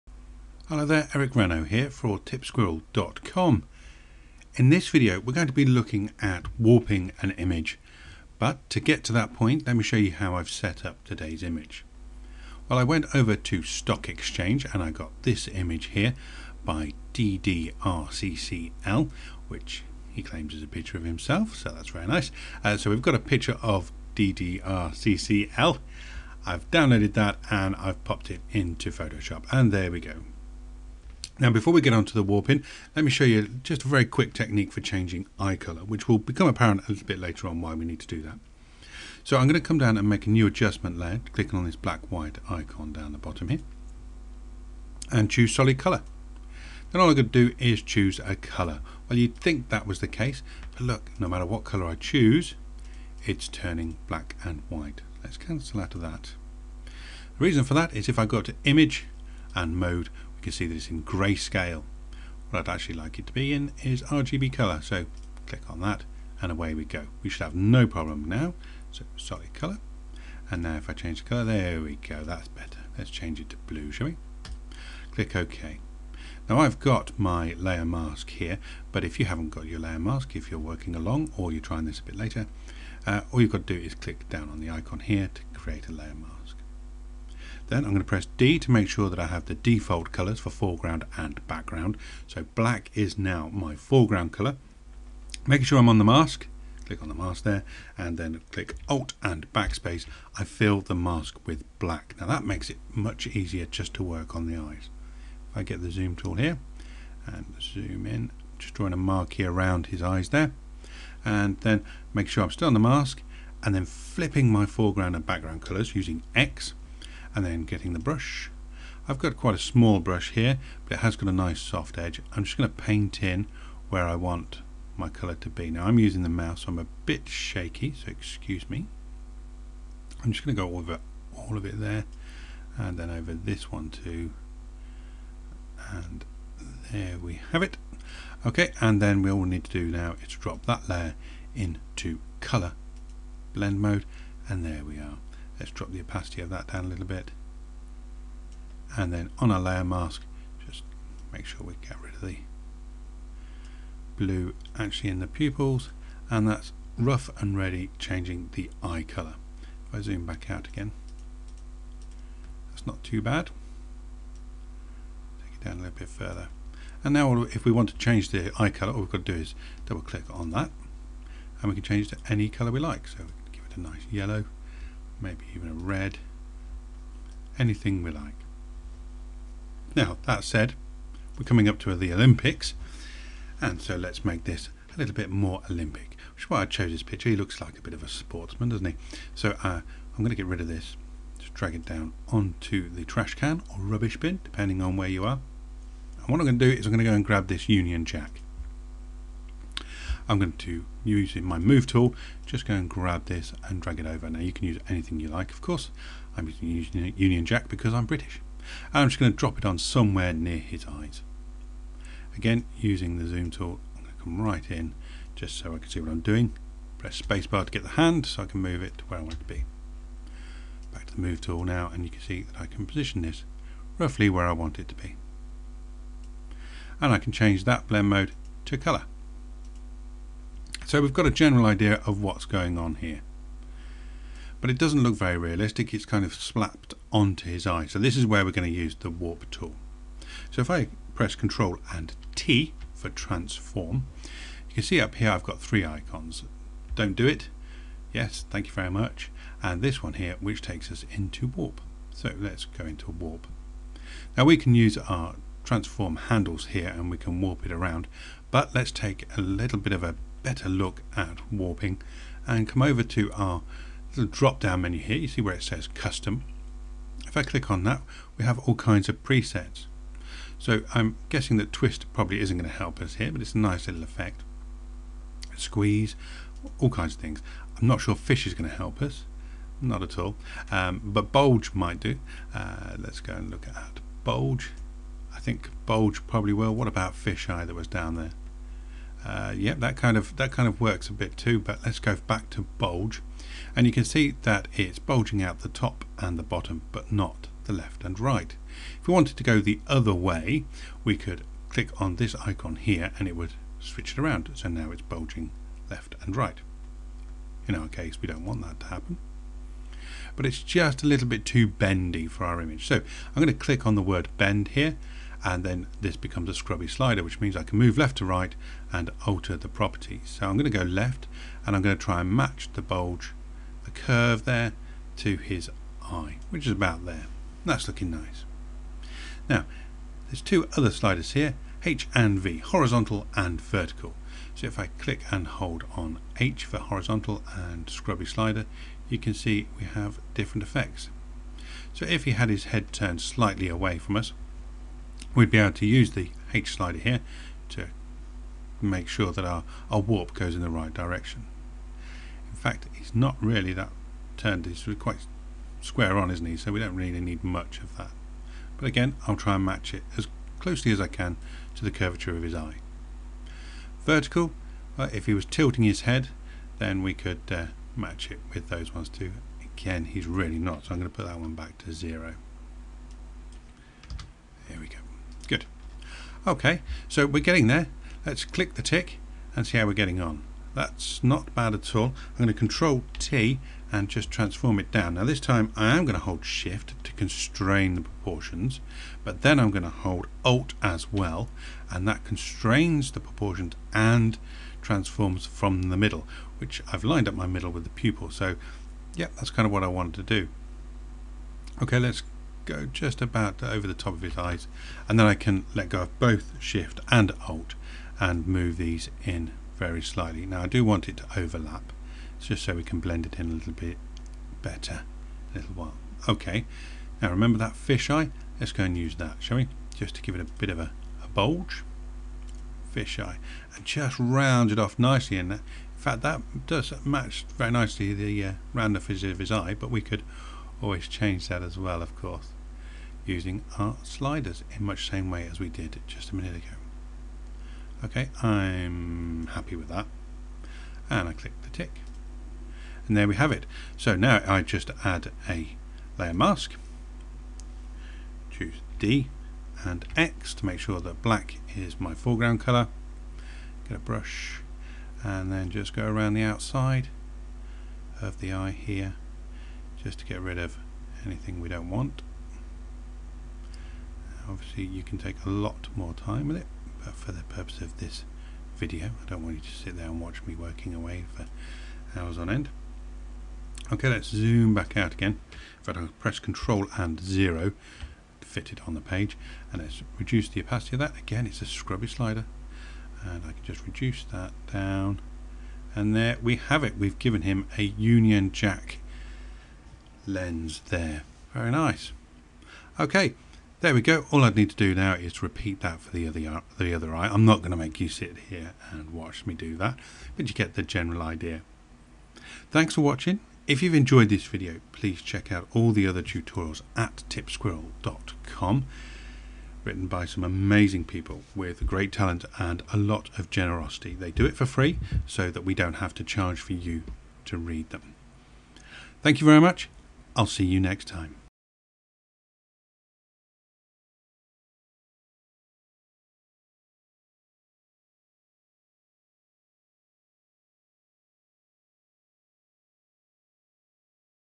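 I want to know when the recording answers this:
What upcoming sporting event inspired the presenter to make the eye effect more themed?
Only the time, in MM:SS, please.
03:02.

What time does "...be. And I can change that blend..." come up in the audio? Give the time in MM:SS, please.
03:44.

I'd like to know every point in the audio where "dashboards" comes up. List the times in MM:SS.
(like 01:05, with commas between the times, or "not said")
not said.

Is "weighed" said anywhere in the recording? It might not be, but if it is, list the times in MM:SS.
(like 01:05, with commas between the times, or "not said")
not said.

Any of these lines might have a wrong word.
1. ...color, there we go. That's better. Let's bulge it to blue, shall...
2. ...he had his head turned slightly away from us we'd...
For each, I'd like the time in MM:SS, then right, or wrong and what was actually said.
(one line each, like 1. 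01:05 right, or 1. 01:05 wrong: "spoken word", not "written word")
1. 01:11 wrong: "change", not "bulge"
2. 05:42 right.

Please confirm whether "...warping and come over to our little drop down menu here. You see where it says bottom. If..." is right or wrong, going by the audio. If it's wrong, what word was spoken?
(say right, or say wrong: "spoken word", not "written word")
wrong: "custom", not "bottom".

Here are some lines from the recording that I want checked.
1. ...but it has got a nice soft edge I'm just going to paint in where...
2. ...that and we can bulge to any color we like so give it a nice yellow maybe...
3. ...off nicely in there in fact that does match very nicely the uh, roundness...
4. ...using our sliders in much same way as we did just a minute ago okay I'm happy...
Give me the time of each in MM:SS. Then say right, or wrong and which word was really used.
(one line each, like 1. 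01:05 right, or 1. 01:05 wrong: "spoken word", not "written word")
1. 02:00 right
2. 02:50 wrong: "change", not "bulge"
3. 07:04 right
4. 07:13 right.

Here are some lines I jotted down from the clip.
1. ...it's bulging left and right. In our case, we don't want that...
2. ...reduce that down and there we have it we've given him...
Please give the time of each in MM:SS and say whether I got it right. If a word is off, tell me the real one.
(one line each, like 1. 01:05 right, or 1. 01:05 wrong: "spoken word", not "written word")
1. 05:04 right
2. 08:03 right.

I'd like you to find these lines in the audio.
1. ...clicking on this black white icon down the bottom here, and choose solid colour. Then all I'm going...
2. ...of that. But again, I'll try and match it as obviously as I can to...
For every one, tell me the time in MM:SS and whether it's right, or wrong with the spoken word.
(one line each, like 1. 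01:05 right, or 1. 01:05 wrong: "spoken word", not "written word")
1. 00:41 right
2. 05:57 wrong: "closely", not "obviously".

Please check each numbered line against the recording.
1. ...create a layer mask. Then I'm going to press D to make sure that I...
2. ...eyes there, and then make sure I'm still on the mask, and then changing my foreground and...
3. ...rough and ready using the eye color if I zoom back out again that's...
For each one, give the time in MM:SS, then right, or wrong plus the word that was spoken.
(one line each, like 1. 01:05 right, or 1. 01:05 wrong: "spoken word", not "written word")
1. 01:25 right
2. 01:50 wrong: "flipping", not "changing"
3. 02:36 wrong: "changing", not "using".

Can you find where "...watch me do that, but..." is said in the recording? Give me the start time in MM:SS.
08:19.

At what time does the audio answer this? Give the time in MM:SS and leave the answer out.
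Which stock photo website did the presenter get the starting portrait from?
00:13.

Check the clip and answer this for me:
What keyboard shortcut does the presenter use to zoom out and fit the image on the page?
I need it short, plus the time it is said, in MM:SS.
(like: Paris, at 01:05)
Control and 0, at 07:56.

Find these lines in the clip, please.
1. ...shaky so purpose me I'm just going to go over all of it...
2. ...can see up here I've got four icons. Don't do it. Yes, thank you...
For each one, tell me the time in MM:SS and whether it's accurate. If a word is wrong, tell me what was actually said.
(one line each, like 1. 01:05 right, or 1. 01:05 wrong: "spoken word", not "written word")
1. 02:07 wrong: "excuse", not "purpose"
2. 04:04 wrong: "three", not "four".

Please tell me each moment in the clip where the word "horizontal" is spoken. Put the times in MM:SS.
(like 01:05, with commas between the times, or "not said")
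05:32, 05:36.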